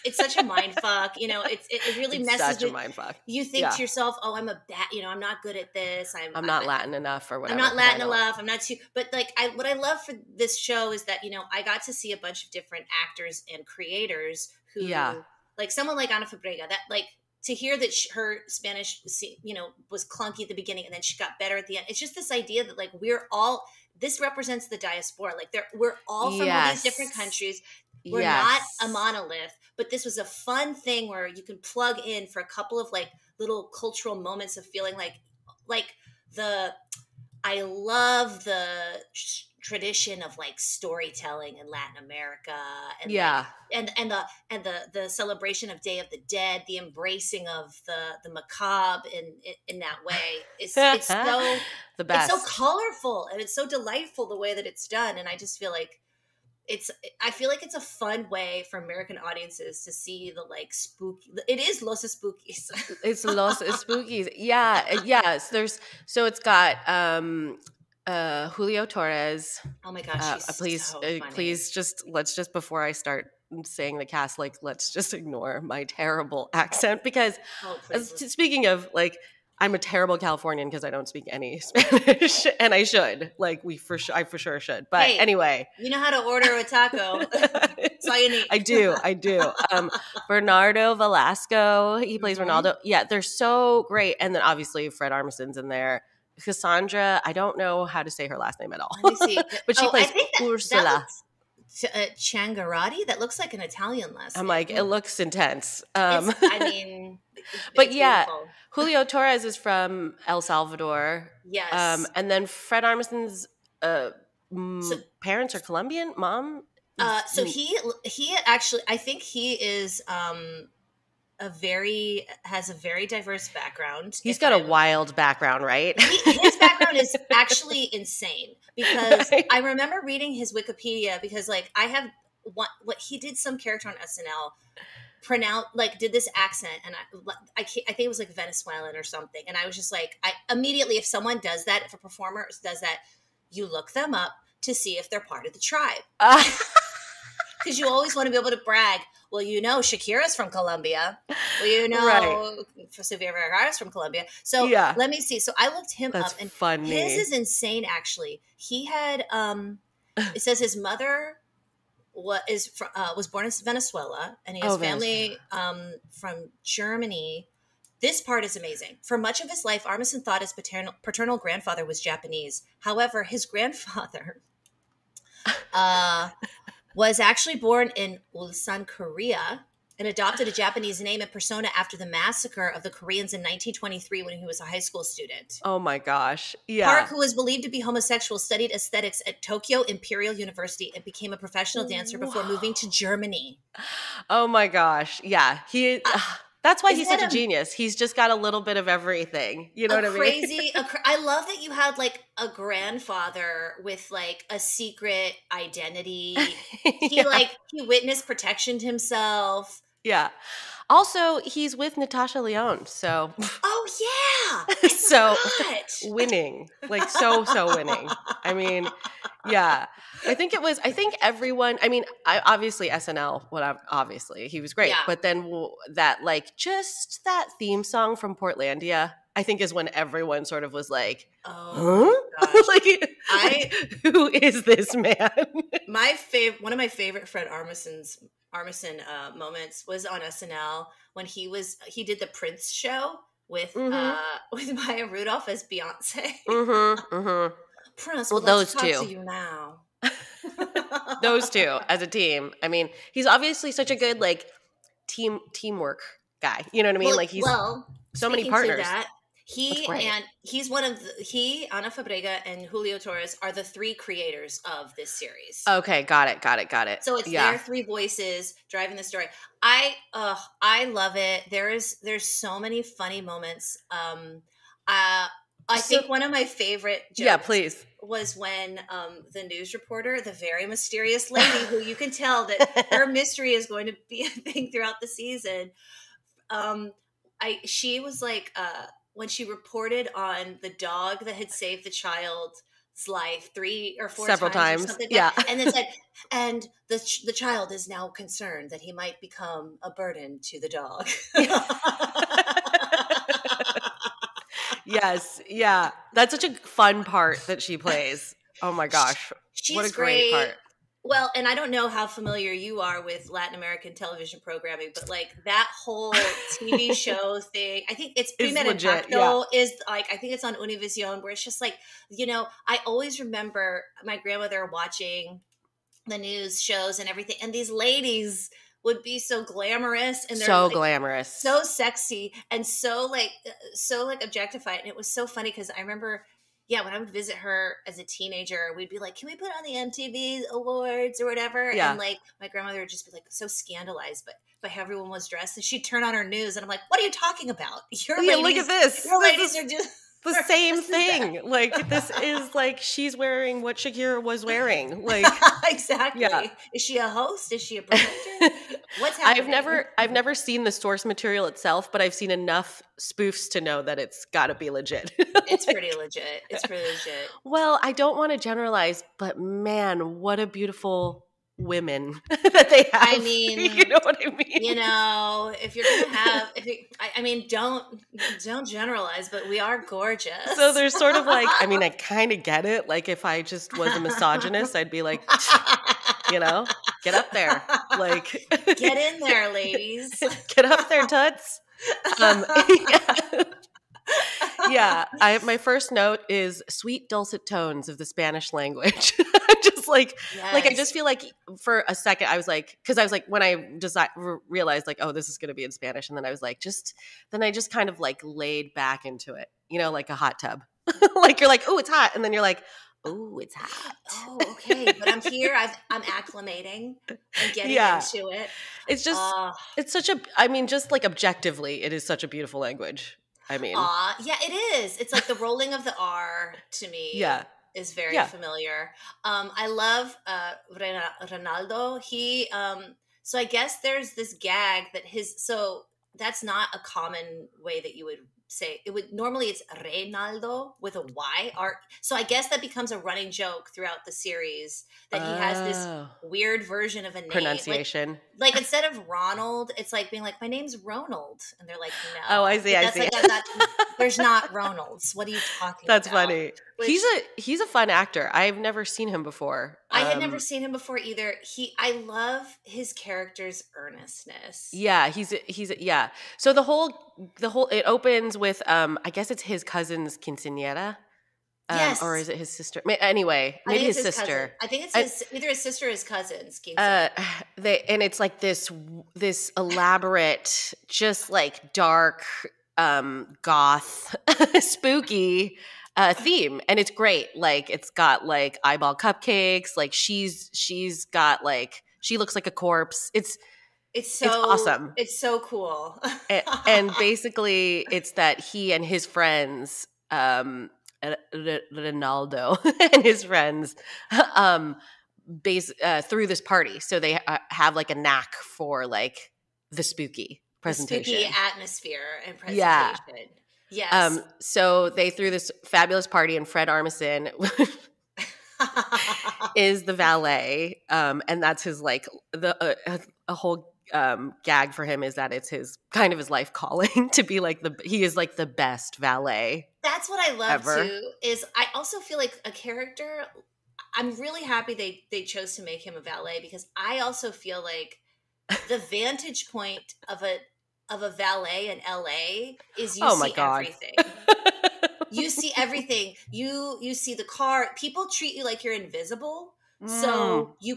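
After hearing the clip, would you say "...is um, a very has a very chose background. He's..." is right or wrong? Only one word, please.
wrong.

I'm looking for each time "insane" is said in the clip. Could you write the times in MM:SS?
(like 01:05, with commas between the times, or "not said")
02:07, 02:37.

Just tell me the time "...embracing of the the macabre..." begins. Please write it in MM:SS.
00:46.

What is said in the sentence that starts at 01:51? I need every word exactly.
Yes, um, and then Fred Armisen's uh, so, parents are Colombian.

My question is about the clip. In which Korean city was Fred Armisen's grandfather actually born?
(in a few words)
Ulsan.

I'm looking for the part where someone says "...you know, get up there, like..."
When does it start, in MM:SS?
06:26.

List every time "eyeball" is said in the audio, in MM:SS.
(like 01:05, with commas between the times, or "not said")
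08:08.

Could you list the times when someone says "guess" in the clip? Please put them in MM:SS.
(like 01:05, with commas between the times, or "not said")
07:13, 07:22, 07:49.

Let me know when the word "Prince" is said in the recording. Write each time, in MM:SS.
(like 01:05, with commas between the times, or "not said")
04:02, 04:07.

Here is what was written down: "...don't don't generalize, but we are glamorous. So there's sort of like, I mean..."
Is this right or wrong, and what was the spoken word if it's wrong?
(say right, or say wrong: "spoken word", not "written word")
wrong: "gorgeous", not "glamorous".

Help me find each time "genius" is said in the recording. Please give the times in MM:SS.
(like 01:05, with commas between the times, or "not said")
03:17.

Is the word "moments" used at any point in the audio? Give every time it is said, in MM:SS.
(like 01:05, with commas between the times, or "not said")
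00:34, 03:59, 04:33.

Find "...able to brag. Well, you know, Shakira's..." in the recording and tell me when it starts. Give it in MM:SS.
02:28.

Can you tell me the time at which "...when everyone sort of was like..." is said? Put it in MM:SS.
03:49.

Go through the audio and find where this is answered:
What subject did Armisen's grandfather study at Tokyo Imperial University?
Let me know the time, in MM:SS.
03:08.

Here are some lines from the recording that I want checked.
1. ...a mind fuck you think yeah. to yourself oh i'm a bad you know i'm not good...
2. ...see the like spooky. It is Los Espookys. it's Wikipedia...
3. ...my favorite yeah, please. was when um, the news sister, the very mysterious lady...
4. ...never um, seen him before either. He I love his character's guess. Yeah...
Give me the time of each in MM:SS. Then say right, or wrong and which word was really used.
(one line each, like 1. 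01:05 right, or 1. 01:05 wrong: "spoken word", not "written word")
1. 00:02 right
2. 00:59 wrong: "Los", not "Wikipedia"
3. 04:36 wrong: "reporter", not "sister"
4. 07:40 wrong: "earnestness", not "guess".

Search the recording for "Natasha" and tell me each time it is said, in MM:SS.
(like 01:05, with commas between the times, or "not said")
03:31.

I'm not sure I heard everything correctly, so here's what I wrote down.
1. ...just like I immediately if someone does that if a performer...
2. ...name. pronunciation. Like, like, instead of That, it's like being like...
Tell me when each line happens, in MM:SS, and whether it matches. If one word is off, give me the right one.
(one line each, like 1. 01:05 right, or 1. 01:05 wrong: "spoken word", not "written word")
1. 02:19 right
2. 07:27 wrong: "Ronald", not "That".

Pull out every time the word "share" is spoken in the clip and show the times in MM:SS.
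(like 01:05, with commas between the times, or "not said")
not said.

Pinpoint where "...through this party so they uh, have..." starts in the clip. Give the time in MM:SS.
08:26.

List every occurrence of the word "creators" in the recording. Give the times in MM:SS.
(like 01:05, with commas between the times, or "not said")
00:13, 04:23.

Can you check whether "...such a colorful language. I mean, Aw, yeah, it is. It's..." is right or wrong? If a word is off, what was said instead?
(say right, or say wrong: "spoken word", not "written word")
wrong: "beautiful", not "colorful".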